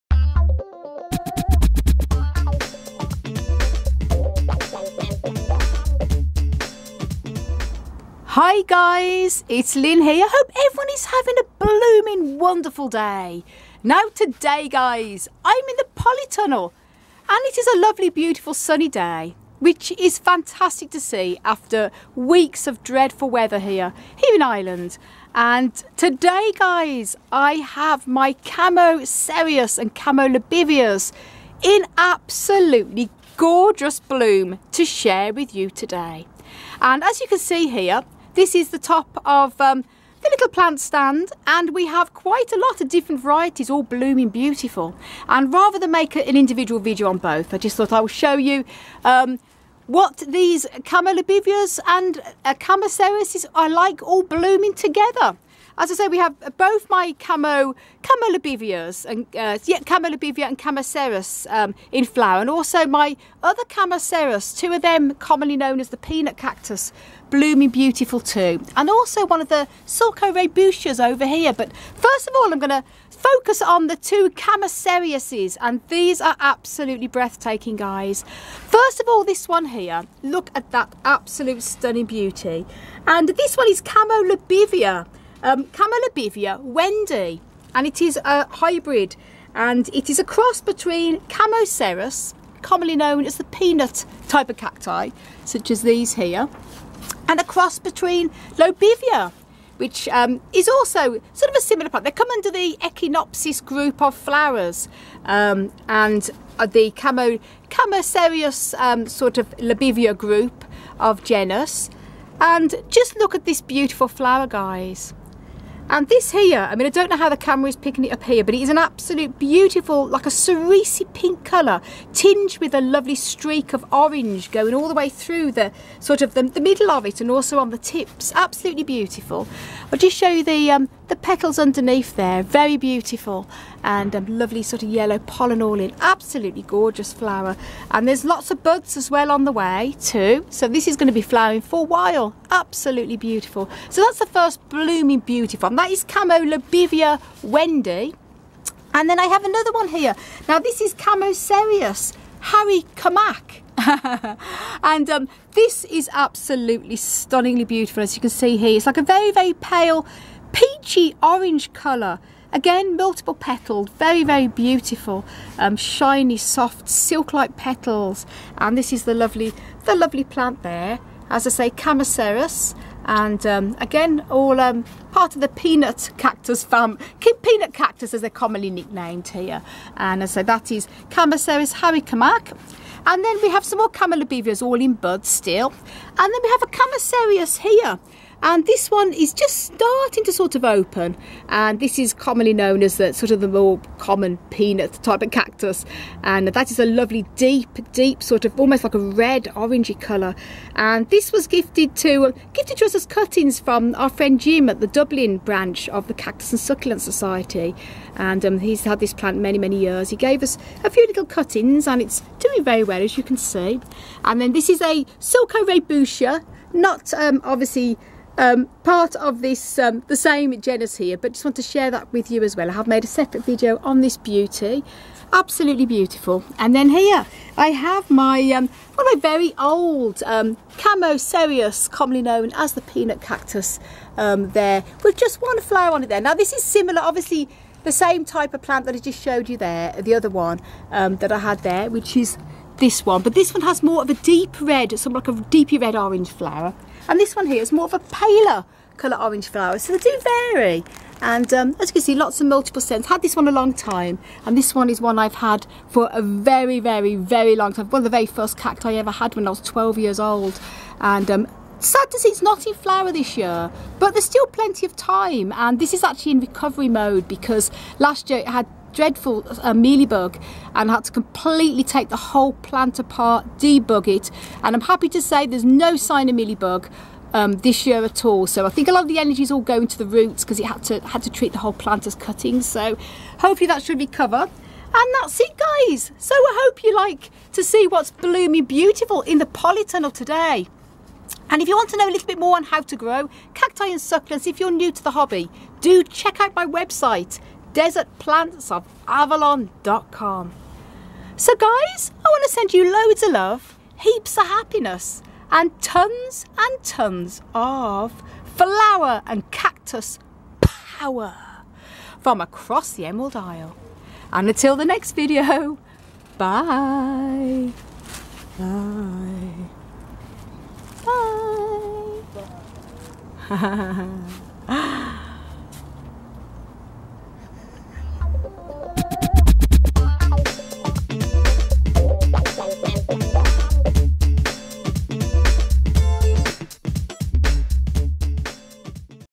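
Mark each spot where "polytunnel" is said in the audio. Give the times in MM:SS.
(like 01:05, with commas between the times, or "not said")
00:15, 04:49.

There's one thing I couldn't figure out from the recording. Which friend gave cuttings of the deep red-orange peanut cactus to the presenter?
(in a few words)
Jim.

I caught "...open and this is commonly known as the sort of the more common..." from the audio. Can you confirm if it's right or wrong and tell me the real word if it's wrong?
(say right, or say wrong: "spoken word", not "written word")
right.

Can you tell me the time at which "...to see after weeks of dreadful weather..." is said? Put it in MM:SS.
00:20.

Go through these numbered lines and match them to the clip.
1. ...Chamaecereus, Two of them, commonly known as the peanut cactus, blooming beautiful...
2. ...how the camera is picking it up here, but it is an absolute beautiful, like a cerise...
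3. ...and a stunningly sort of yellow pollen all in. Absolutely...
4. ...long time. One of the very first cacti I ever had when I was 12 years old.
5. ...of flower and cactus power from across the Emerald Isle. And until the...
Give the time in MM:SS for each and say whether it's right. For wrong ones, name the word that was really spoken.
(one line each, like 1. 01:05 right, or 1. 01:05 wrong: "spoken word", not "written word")
1. 01:03 right
2. 01:57 right
3. 02:13 wrong: "lovely", not "stunningly"
4. 04:17 right
5. 05:07 right.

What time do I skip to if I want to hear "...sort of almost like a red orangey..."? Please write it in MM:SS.
03:18.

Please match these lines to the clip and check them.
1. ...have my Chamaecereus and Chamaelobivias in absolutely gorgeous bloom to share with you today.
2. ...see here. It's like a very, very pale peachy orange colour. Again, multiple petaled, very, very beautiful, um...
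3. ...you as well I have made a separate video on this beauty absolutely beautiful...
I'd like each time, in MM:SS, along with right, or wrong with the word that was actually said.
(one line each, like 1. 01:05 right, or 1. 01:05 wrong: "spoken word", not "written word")
1. 00:27 right
2. 02:38 right
3. 03:42 right.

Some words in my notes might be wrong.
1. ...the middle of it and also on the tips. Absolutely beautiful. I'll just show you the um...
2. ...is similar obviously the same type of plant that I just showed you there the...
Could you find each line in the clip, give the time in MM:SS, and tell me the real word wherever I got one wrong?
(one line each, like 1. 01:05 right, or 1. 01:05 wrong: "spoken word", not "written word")
1. 02:06 right
2. 03:56 right.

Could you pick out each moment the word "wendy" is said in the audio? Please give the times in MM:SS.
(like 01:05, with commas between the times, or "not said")
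01:26, 02:27.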